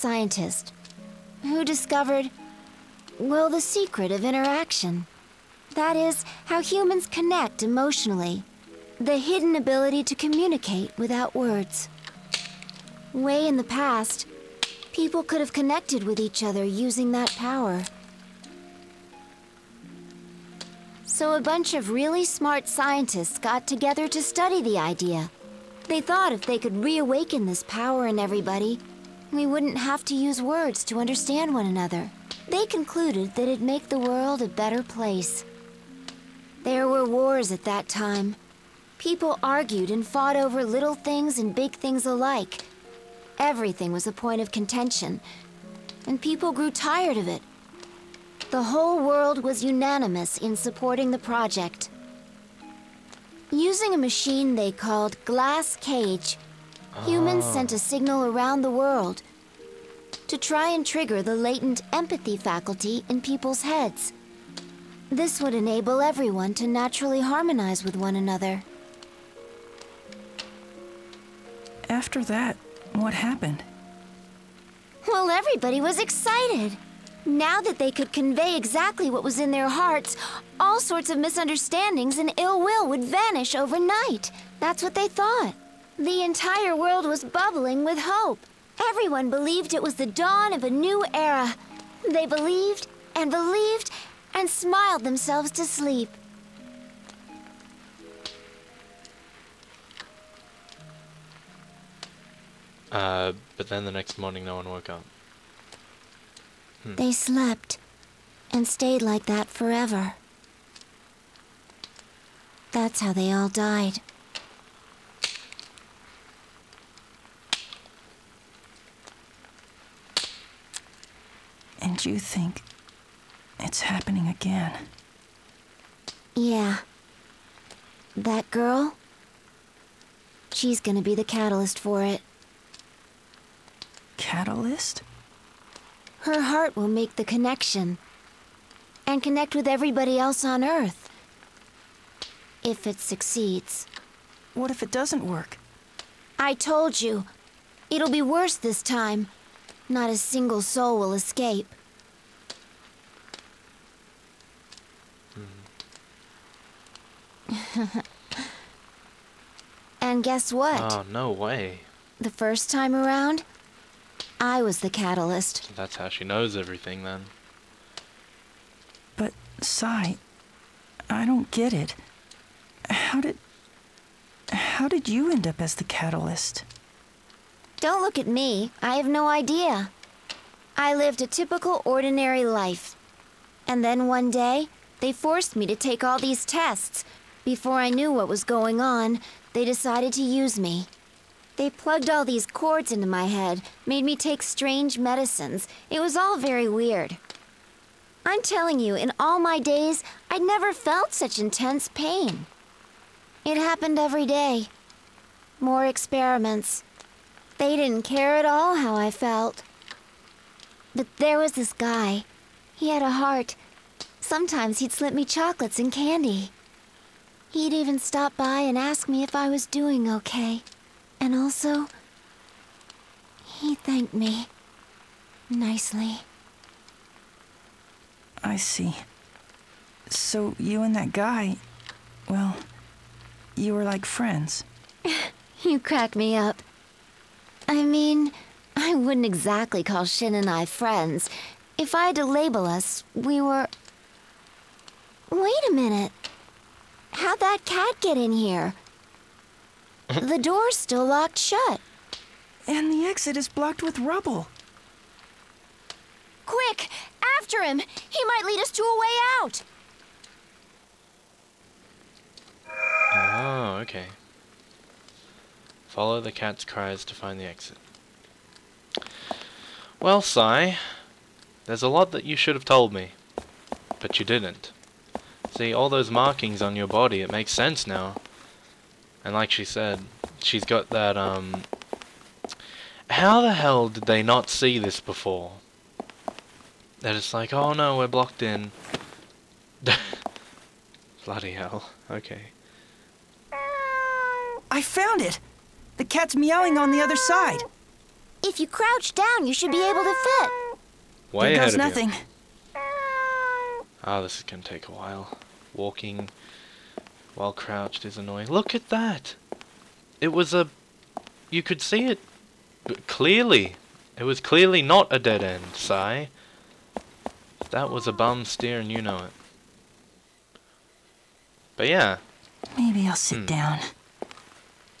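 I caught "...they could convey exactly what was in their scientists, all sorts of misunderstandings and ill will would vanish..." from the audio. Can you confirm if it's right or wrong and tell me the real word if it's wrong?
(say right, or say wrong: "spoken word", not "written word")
wrong: "hearts", not "scientists".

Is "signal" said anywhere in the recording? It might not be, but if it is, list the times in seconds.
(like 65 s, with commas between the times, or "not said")
57 s.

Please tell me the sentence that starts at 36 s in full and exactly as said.
There were wars at that time.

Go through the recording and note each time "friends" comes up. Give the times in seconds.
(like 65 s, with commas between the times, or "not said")
234 s, 240 s.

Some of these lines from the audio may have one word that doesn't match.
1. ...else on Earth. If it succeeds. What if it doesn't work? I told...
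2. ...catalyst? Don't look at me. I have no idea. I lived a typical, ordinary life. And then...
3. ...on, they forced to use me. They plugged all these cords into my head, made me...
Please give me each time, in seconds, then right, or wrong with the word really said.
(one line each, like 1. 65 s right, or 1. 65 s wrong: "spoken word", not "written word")
1. 140 s right
2. 175 s right
3. 188 s wrong: "decided", not "forced".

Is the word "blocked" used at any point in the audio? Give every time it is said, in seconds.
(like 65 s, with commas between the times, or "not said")
253 s, 288 s.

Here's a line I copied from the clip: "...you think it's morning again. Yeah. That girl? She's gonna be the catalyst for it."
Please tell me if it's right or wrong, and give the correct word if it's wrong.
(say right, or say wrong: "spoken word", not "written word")
wrong: "happening", not "morning".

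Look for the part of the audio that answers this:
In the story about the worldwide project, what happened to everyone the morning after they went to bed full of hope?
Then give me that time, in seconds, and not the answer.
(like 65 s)
104 s.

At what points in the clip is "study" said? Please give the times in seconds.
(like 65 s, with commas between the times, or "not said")
24 s.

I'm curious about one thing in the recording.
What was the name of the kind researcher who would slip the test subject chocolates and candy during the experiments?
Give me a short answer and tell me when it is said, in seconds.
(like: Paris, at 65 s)
Shin, at 240 s.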